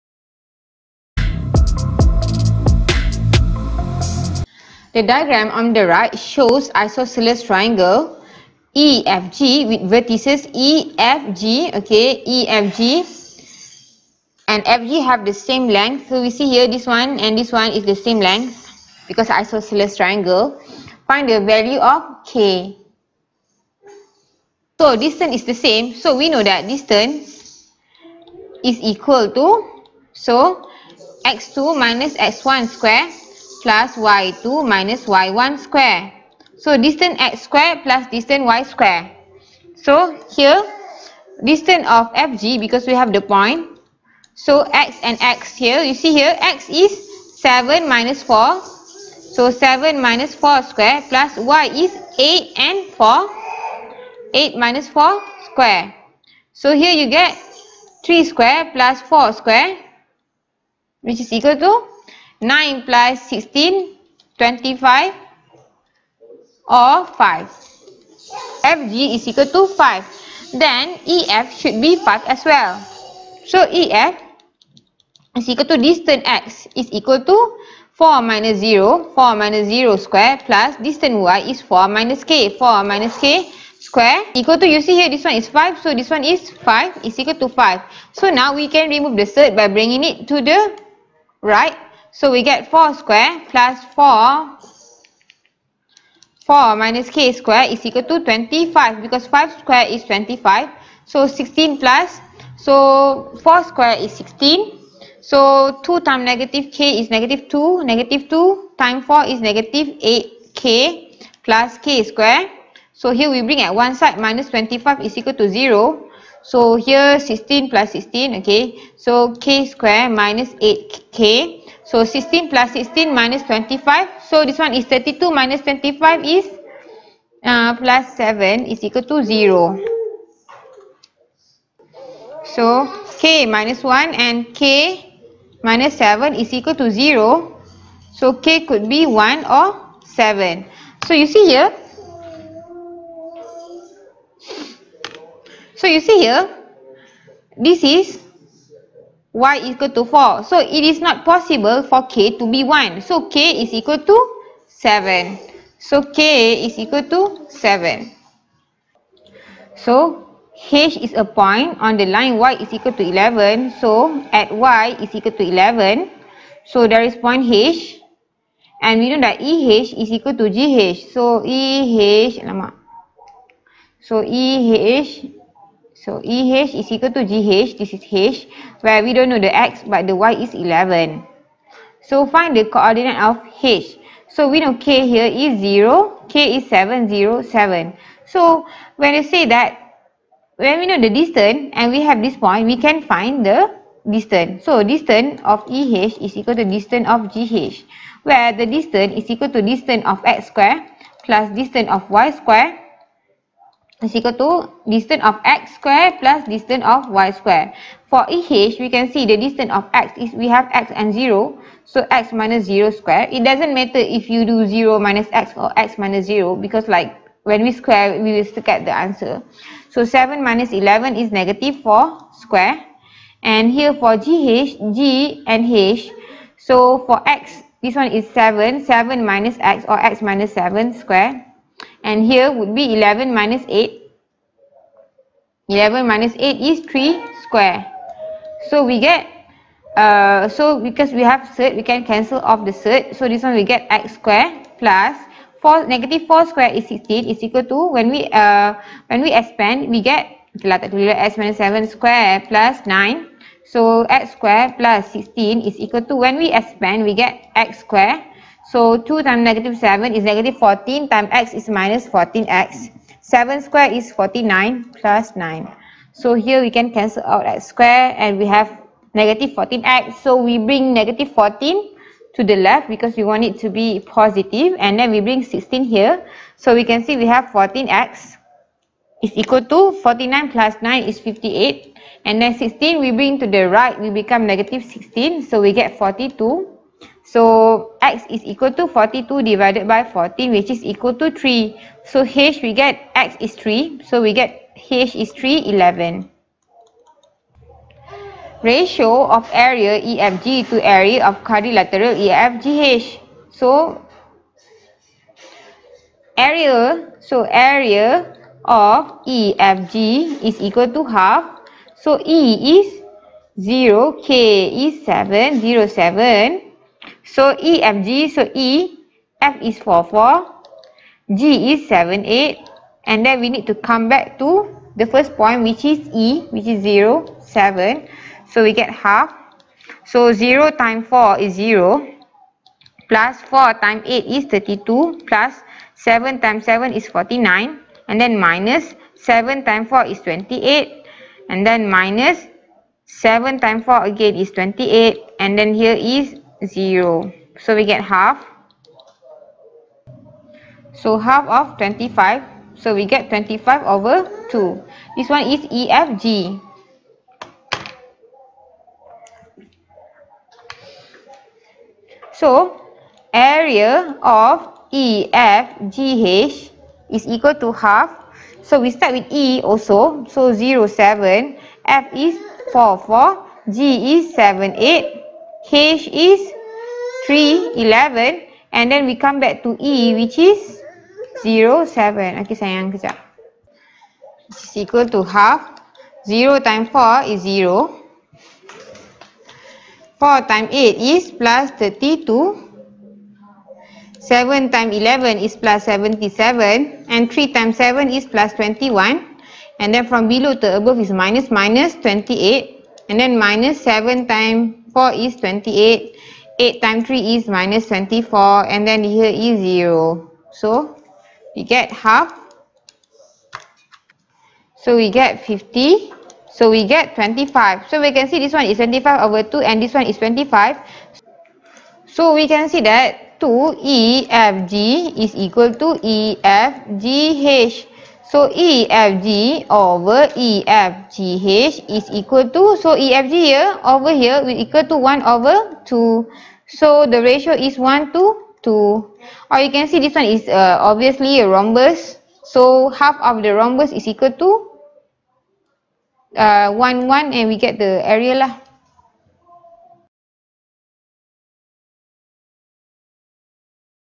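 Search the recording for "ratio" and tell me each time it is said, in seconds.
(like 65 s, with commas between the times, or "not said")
298 s, 437 s.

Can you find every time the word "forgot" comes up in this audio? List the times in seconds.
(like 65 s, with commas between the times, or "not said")
not said.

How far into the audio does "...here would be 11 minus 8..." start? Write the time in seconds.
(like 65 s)
232 s.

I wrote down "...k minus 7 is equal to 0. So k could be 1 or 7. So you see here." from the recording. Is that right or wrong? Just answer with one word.
right.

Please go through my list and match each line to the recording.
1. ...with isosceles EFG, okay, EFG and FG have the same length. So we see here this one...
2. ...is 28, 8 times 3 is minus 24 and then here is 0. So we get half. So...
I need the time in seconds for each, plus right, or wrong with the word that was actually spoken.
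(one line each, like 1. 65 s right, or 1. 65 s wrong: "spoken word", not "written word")
1. 9 s wrong: "vertices", not "isosceles"
2. 405 s right.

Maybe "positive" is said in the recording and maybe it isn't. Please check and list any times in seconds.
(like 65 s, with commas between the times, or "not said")
274 s.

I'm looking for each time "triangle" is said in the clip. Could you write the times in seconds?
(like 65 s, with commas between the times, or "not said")
7 s, 19 s.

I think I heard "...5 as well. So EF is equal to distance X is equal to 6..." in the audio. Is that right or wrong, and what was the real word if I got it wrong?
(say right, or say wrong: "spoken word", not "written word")
wrong: "4", not "6".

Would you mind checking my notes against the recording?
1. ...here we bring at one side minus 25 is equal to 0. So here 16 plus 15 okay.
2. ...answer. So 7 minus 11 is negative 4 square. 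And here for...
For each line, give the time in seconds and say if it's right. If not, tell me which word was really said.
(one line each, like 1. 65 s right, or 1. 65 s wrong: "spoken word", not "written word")
1. 113 s wrong: "16", not "15"
2. 218 s right.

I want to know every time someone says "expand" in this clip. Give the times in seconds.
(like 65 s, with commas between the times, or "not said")
249 s, 256 s.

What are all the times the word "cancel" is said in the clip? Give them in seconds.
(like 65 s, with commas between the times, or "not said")
242 s, 266 s.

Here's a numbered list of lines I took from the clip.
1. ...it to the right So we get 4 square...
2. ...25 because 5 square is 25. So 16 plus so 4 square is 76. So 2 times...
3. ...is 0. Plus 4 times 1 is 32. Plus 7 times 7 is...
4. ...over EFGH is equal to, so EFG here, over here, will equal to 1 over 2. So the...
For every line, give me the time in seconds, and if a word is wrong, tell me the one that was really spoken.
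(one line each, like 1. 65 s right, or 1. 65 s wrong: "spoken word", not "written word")
1. 90 s right
2. 98 s wrong: "16", not "76"
3. 331 s wrong: "8", not "1"
4. 429 s right.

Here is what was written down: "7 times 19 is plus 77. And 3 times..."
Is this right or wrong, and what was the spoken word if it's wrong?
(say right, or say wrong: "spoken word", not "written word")
wrong: "11", not "19".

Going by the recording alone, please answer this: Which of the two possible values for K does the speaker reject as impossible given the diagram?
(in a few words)
1.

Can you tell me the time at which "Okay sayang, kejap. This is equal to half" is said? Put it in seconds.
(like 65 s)
382 s.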